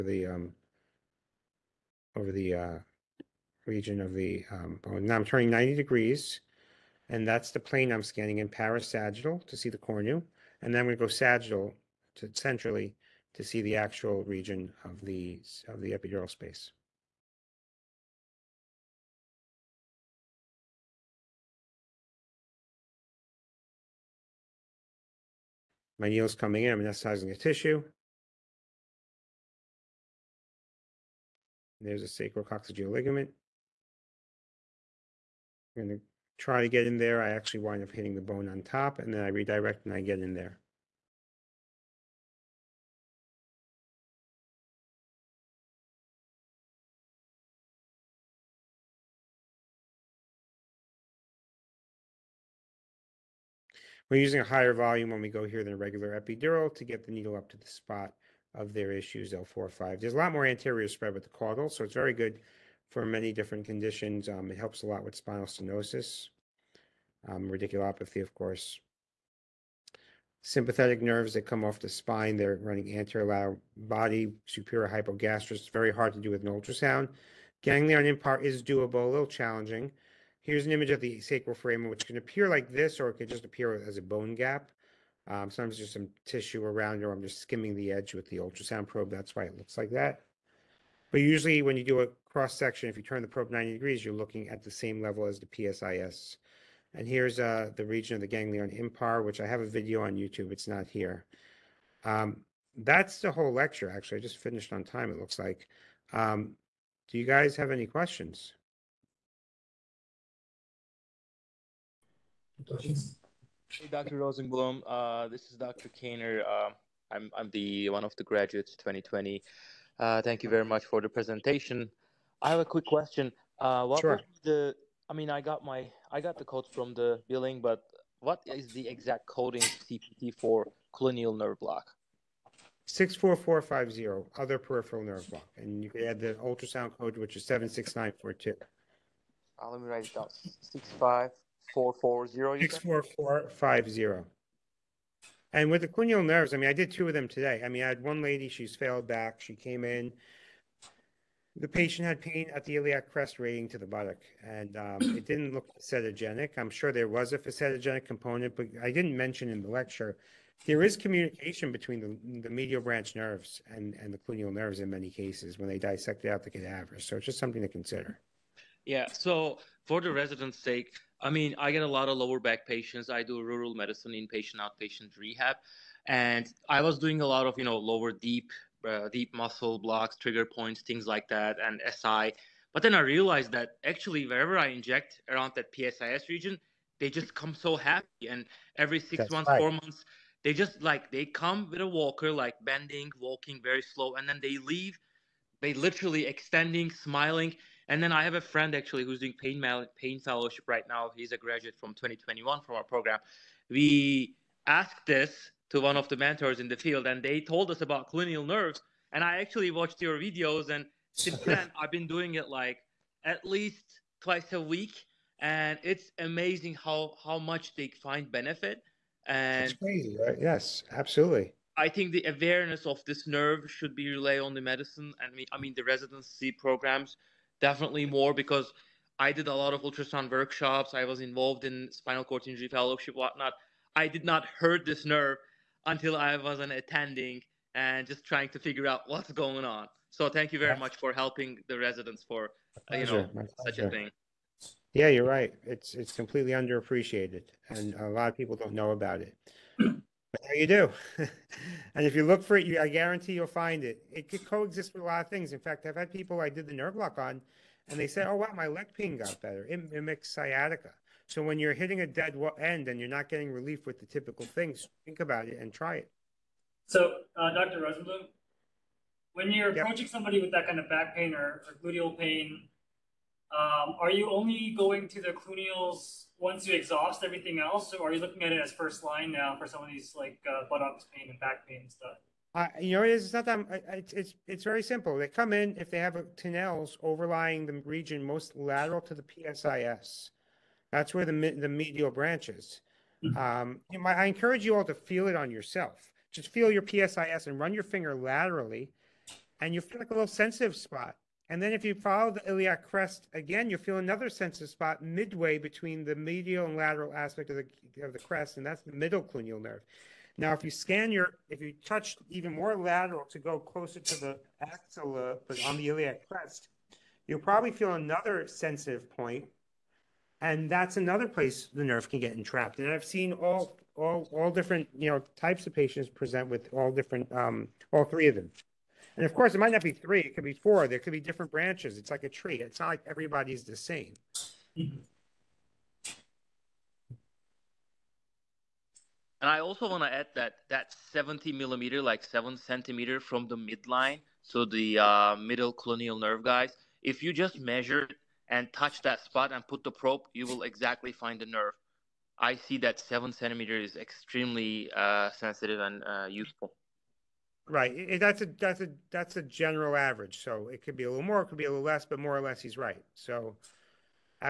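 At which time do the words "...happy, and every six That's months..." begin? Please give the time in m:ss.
3:07.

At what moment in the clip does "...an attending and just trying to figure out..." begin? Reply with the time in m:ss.
3:56.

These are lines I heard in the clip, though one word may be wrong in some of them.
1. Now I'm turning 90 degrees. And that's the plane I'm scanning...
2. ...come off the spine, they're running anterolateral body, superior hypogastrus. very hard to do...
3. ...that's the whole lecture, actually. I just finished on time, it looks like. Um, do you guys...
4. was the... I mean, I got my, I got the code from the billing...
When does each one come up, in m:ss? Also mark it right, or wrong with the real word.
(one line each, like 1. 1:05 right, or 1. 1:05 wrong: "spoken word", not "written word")
1. 0:05 right
2. 1:11 right
3. 1:42 right
4. 2:04 right.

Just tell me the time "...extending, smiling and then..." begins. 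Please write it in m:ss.
3:16.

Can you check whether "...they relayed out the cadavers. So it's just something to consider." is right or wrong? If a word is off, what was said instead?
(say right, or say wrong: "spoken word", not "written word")
wrong: "dissected", not "relayed".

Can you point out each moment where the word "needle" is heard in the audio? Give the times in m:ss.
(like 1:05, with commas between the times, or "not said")
0:26, 0:57.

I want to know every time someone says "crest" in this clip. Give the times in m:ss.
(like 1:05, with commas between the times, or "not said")
2:33, 5:02, 5:08, 5:16.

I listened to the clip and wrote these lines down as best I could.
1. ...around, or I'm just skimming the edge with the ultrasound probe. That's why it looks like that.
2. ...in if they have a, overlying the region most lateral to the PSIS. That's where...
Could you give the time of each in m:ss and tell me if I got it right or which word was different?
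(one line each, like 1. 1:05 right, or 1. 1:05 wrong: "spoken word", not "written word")
1. 1:26 right
2. 4:45 right.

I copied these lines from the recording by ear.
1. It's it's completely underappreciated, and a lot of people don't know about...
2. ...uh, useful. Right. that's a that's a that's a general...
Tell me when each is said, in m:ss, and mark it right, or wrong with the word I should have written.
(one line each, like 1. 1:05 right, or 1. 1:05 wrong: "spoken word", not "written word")
1. 4:05 right
2. 5:56 right.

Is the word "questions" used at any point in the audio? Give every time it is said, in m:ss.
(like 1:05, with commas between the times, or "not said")
1:47, 2:02.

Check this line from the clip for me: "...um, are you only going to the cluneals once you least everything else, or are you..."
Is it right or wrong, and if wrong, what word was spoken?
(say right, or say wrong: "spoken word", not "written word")
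wrong: "exhaust", not "least".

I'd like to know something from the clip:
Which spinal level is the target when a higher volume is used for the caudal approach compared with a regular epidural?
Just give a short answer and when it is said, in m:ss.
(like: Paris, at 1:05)
L4-5, at 0:59.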